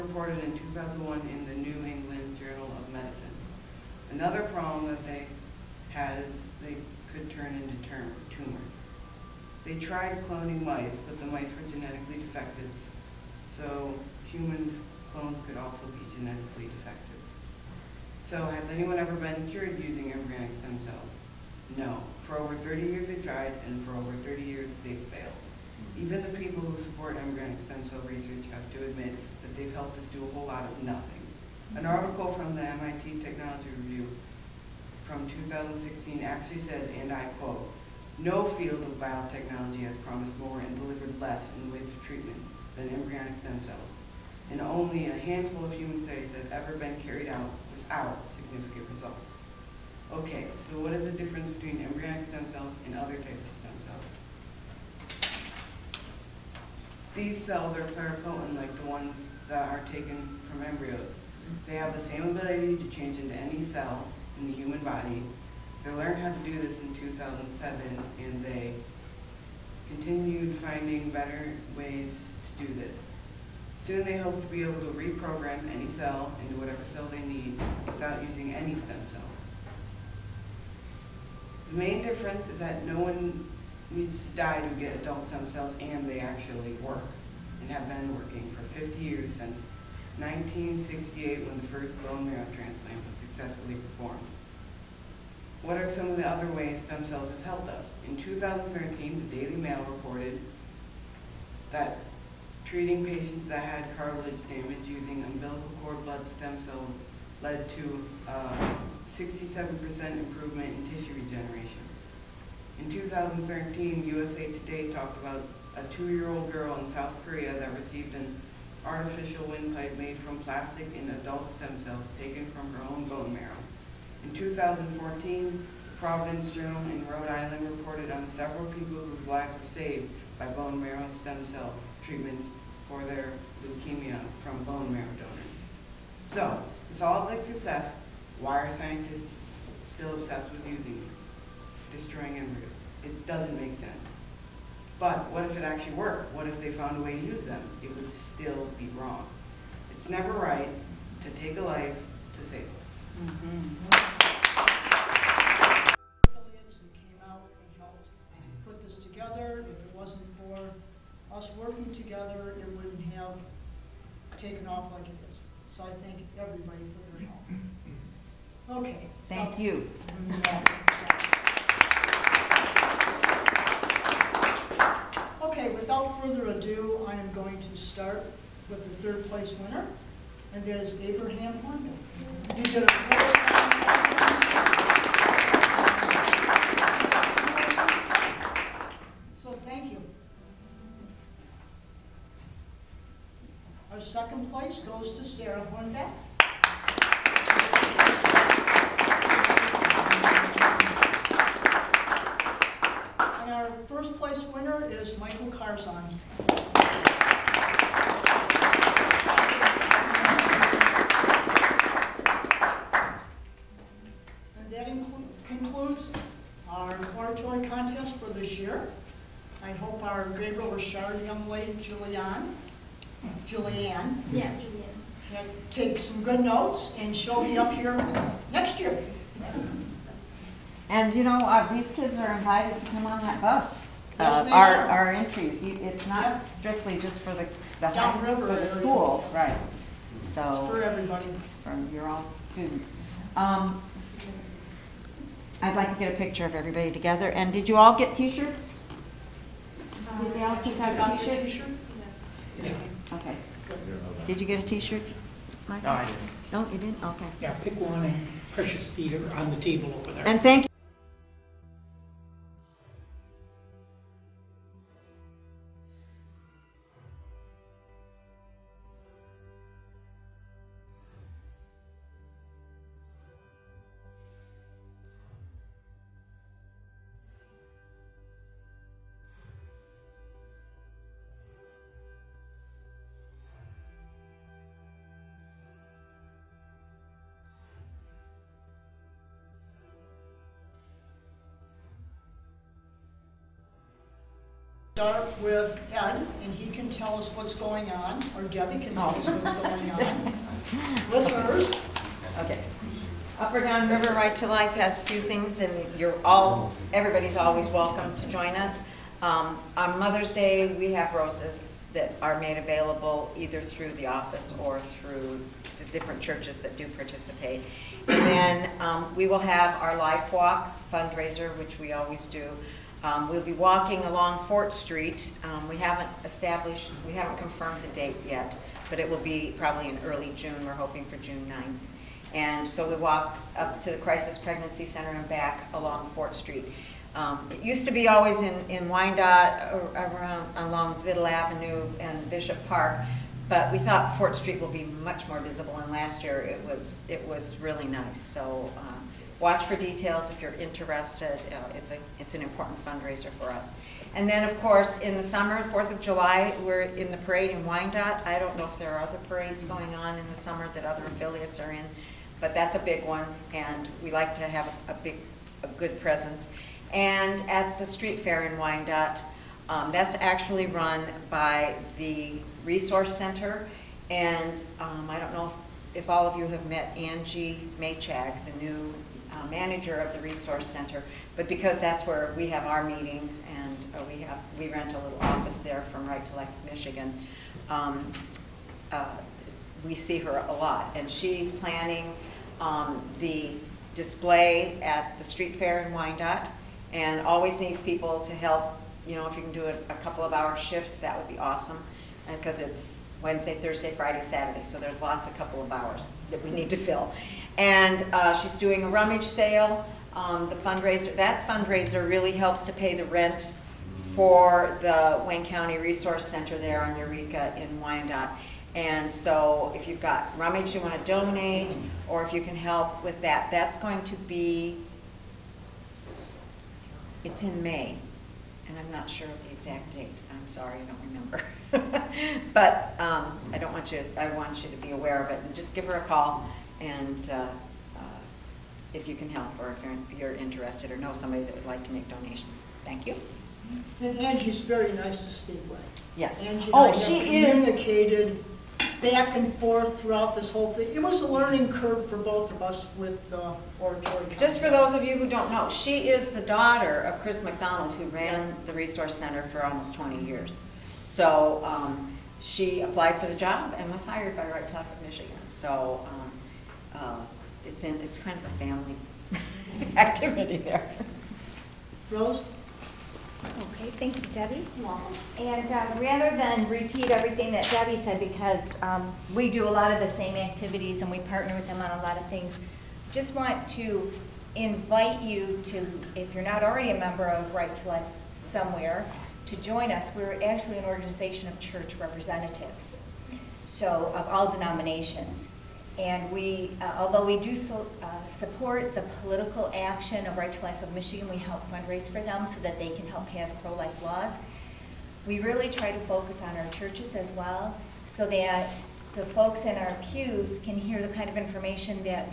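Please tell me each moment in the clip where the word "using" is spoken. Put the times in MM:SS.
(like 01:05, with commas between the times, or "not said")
00:19, 01:18, 01:44, 02:20.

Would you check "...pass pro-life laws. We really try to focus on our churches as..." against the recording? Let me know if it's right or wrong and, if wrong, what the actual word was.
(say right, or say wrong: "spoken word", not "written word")
right.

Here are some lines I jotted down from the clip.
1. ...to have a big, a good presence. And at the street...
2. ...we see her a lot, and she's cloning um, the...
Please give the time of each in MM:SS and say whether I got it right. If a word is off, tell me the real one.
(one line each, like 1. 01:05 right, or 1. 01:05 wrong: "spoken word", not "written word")
1. 06:04 right
2. 06:29 wrong: "planning", not "cloning".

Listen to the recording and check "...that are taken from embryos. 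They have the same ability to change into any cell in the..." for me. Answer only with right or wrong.
right.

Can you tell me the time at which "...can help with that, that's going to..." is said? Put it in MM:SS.
07:02.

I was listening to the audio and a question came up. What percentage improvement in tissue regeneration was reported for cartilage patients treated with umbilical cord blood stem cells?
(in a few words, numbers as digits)
67%.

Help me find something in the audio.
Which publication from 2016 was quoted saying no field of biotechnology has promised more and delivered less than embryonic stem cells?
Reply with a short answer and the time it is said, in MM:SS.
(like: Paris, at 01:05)
MIT Technology Review, at 00:32.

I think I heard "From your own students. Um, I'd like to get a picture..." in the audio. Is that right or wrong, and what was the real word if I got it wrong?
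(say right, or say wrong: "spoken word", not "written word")
right.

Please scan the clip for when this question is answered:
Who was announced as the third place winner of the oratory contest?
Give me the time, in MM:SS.
03:01.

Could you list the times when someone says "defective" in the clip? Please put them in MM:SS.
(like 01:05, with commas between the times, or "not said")
00:12, 00:16.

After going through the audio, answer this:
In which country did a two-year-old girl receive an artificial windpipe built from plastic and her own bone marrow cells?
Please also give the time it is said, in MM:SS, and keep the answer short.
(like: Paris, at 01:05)
South Korea, at 01:56.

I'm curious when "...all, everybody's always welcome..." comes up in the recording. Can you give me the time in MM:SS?
05:06.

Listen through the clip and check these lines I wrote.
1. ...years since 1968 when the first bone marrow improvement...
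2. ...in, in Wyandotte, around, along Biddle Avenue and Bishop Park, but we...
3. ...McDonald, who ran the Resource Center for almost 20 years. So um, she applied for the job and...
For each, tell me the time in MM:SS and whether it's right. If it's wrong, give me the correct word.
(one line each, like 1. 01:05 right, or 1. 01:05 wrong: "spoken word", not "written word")
1. 01:29 wrong: "transplant", not "improvement"
2. 05:38 right
3. 07:37 right.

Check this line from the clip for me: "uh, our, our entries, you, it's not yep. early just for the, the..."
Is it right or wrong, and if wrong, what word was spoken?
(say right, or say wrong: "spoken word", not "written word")
wrong: "strictly", not "early".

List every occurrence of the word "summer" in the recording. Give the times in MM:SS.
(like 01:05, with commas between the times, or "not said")
05:55, 06:00.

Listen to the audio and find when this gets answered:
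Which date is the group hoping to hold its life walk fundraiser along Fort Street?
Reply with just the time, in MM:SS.
05:31.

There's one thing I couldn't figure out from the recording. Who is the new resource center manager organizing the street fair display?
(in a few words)
Angie Maychag.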